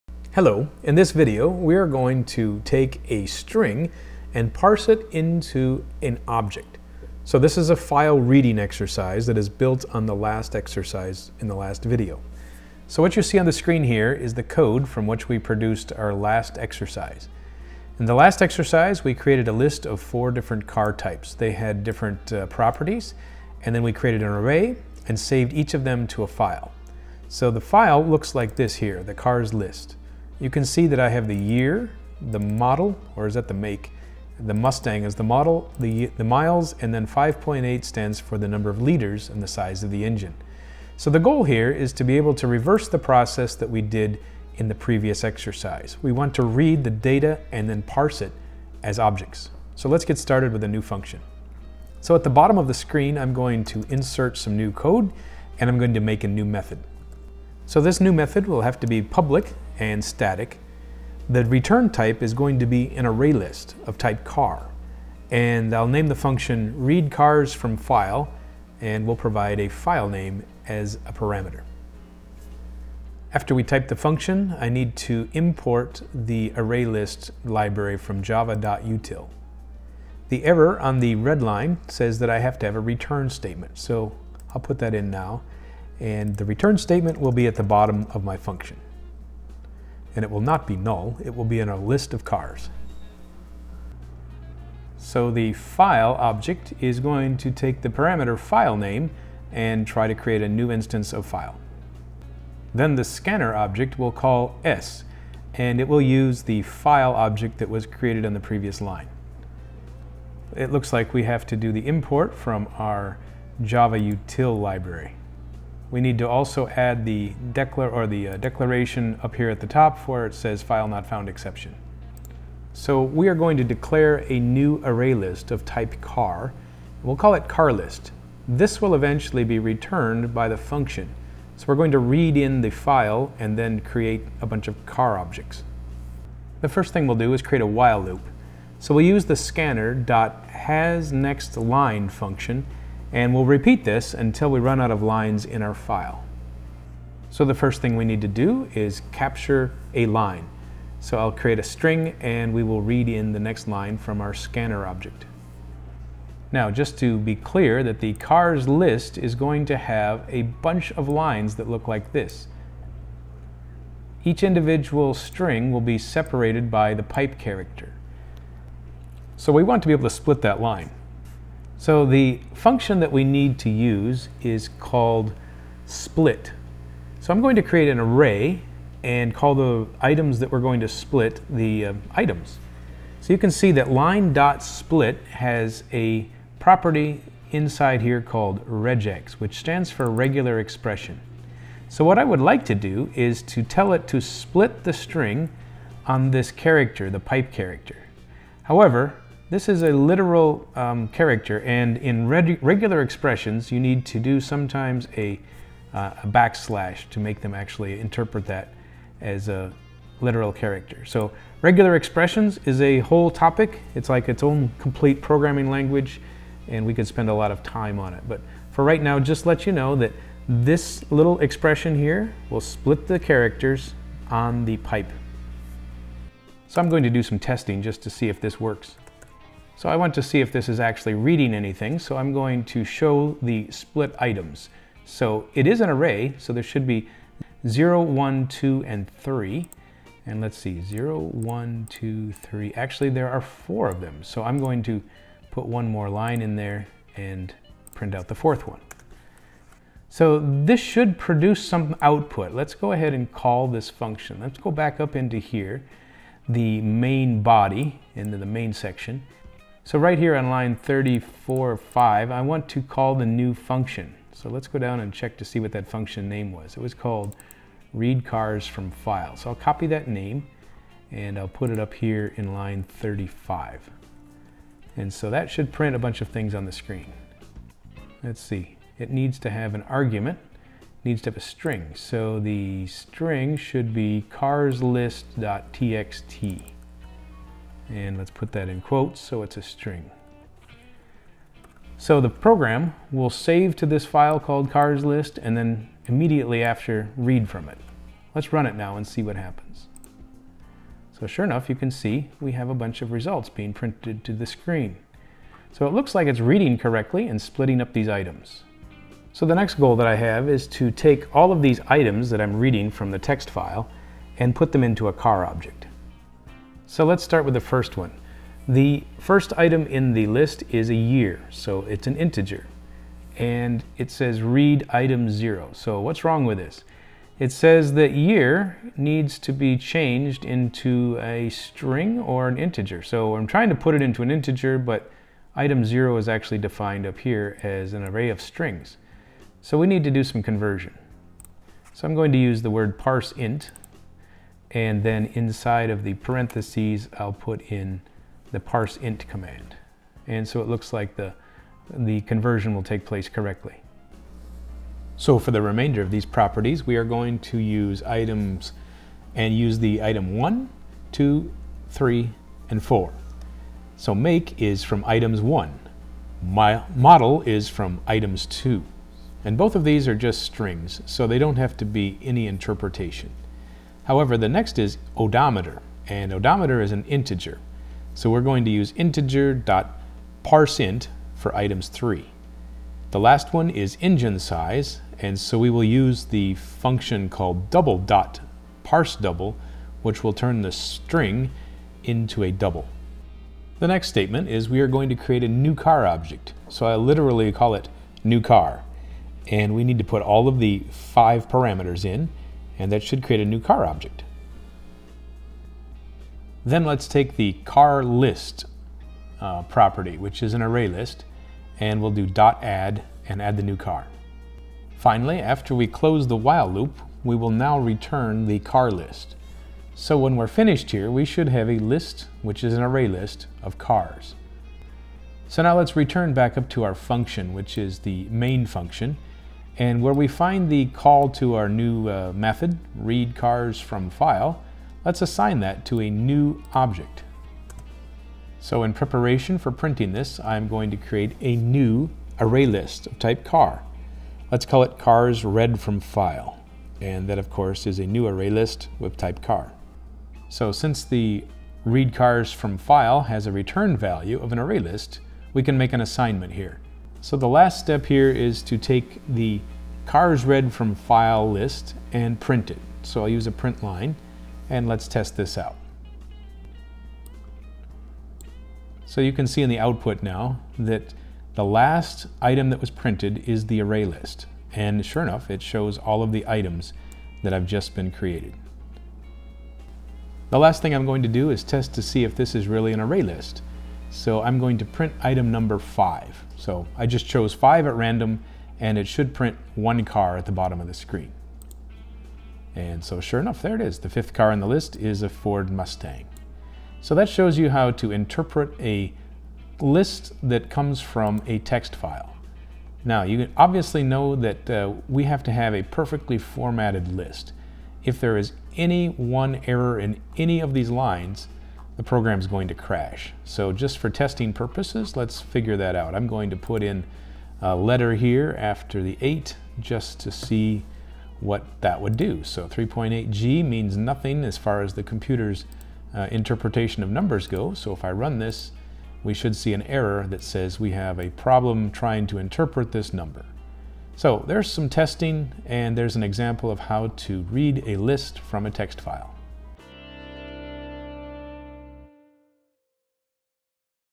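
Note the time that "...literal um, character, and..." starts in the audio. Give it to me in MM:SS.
03:19.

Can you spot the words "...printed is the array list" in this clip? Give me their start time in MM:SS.
07:52.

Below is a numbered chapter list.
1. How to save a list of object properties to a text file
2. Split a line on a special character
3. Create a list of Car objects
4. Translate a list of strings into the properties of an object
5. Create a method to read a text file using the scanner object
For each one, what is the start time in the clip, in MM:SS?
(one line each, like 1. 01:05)
1. 00:10
2. 02:50
3. 02:00
4. 05:15
5. 00:50.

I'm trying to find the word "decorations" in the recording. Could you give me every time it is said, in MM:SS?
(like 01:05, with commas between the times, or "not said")
not said.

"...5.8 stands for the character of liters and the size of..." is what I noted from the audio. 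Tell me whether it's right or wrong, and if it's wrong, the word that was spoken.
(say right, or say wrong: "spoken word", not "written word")
wrong: "number", not "character".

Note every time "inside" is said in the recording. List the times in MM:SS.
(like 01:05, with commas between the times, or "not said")
03:07, 05:45.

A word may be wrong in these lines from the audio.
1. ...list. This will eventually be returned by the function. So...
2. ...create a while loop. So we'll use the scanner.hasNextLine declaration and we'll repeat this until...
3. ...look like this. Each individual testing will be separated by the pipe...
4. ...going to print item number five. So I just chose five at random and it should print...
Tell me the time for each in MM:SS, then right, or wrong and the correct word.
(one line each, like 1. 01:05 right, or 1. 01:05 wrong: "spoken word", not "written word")
1. 02:07 right
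2. 02:17 wrong: "function", not "declaration"
3. 02:41 wrong: "string", not "testing"
4. 08:04 right.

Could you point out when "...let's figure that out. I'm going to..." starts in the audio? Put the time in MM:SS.
08:35.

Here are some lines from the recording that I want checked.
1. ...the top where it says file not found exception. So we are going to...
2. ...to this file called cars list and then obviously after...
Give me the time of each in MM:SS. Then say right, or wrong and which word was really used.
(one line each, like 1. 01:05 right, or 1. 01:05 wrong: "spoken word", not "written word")
1. 01:59 right
2. 04:53 wrong: "immediately", not "obviously".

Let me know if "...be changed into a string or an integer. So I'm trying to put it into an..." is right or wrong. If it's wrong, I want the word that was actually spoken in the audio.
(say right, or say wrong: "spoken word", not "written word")
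right.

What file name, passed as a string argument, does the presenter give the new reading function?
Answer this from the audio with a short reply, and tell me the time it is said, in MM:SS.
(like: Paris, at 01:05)
carslist.txt, at 04:44.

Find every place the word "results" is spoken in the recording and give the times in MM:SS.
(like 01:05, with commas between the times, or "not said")
05:03.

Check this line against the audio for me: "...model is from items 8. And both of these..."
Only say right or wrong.
wrong.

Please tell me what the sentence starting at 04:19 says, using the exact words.
So right here on line 34 5, I want to call the new function.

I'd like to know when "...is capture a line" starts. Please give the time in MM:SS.
02:28.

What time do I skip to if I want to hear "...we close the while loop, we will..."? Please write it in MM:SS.
06:55.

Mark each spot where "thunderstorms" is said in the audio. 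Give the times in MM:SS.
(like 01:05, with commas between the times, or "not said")
not said.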